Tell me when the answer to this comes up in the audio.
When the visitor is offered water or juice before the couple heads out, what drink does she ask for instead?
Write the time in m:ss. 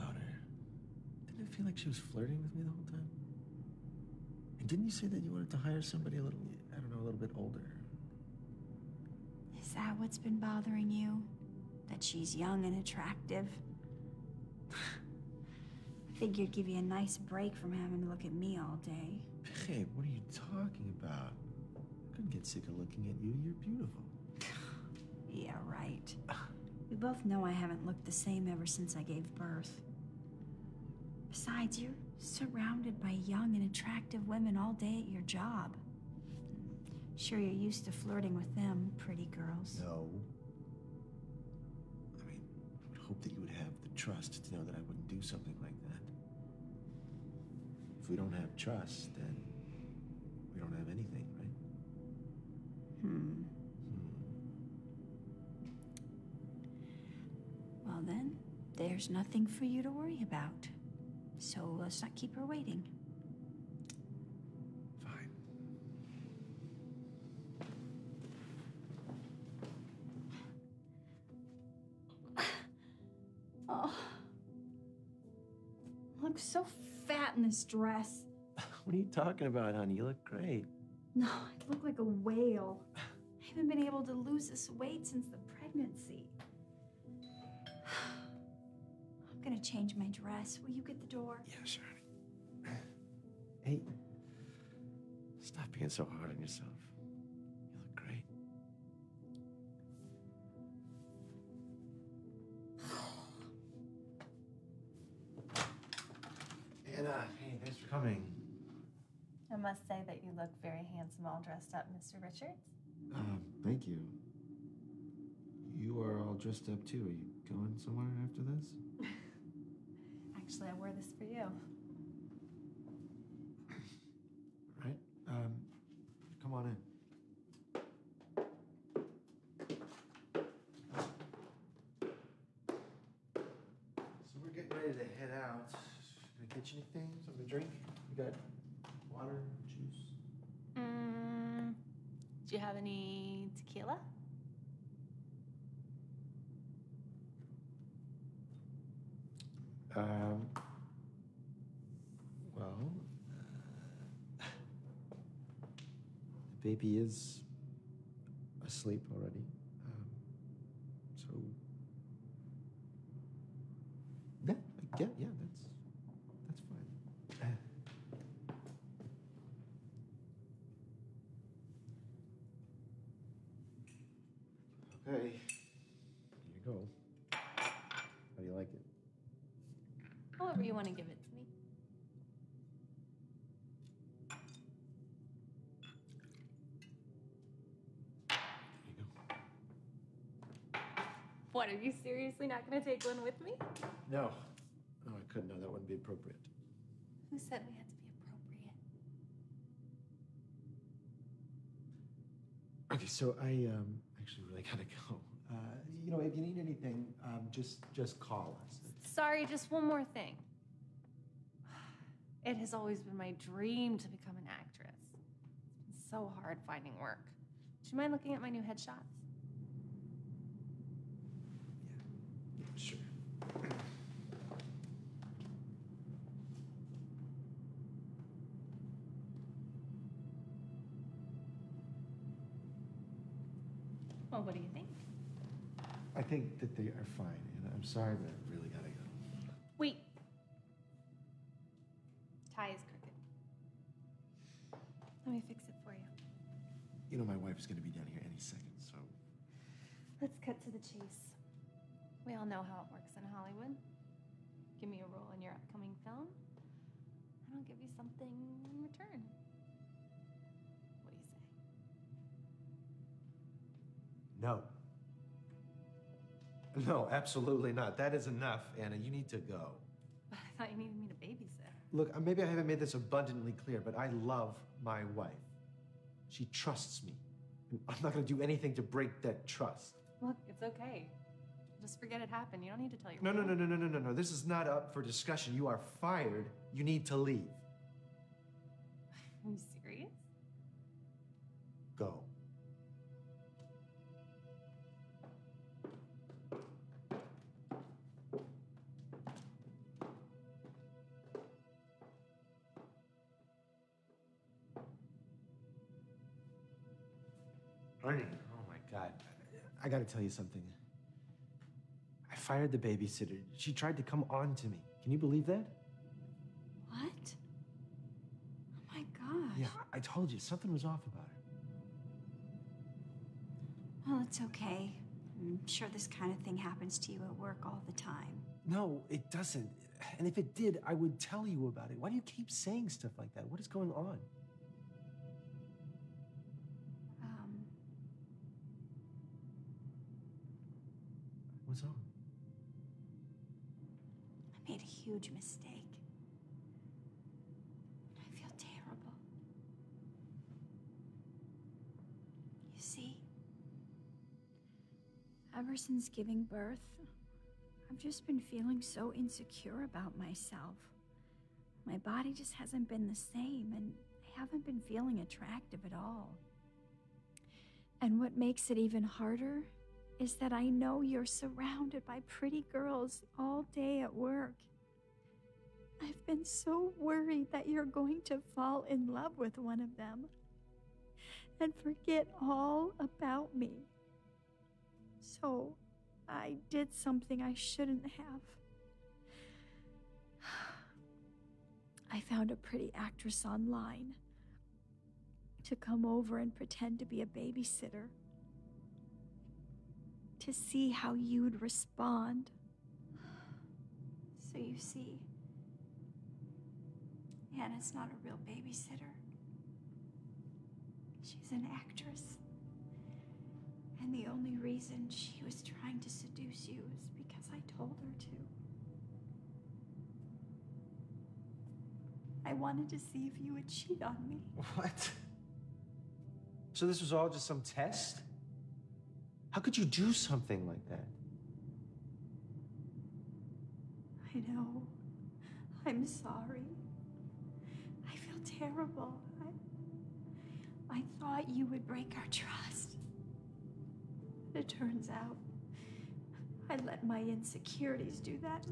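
2:23.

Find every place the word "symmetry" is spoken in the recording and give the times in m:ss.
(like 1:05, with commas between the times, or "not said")
not said.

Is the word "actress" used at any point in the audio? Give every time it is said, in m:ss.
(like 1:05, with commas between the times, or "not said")
3:34, 6:32, 6:51.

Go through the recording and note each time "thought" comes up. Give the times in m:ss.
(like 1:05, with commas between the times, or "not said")
4:30, 7:21.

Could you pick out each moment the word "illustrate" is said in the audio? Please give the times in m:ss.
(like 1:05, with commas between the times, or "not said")
not said.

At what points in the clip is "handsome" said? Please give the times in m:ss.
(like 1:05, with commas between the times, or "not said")
1:50.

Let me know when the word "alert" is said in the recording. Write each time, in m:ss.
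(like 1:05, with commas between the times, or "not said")
not said.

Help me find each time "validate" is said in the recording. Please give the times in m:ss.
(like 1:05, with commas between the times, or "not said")
not said.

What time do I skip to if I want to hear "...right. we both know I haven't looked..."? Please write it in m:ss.
0:25.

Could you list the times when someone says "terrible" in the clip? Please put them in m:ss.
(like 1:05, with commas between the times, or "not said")
5:48, 7:18.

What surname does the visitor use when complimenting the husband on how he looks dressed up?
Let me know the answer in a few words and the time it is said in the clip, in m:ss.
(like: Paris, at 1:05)
Richards, at 1:52.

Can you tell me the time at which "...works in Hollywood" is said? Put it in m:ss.
4:12.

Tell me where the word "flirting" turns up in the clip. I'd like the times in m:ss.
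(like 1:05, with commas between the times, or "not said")
0:01, 0:37.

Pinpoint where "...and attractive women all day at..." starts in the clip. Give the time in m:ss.
0:33.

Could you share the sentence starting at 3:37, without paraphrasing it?
Do you mind looking at my new headshots?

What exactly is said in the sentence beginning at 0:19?
Babe, what are you talking about?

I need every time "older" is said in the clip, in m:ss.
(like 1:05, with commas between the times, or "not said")
0:07.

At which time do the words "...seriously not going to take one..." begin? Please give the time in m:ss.
3:12.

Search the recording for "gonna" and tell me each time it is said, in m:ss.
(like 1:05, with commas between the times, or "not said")
1:29, 4:07.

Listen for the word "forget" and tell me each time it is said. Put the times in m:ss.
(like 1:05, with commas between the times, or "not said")
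4:41, 6:21.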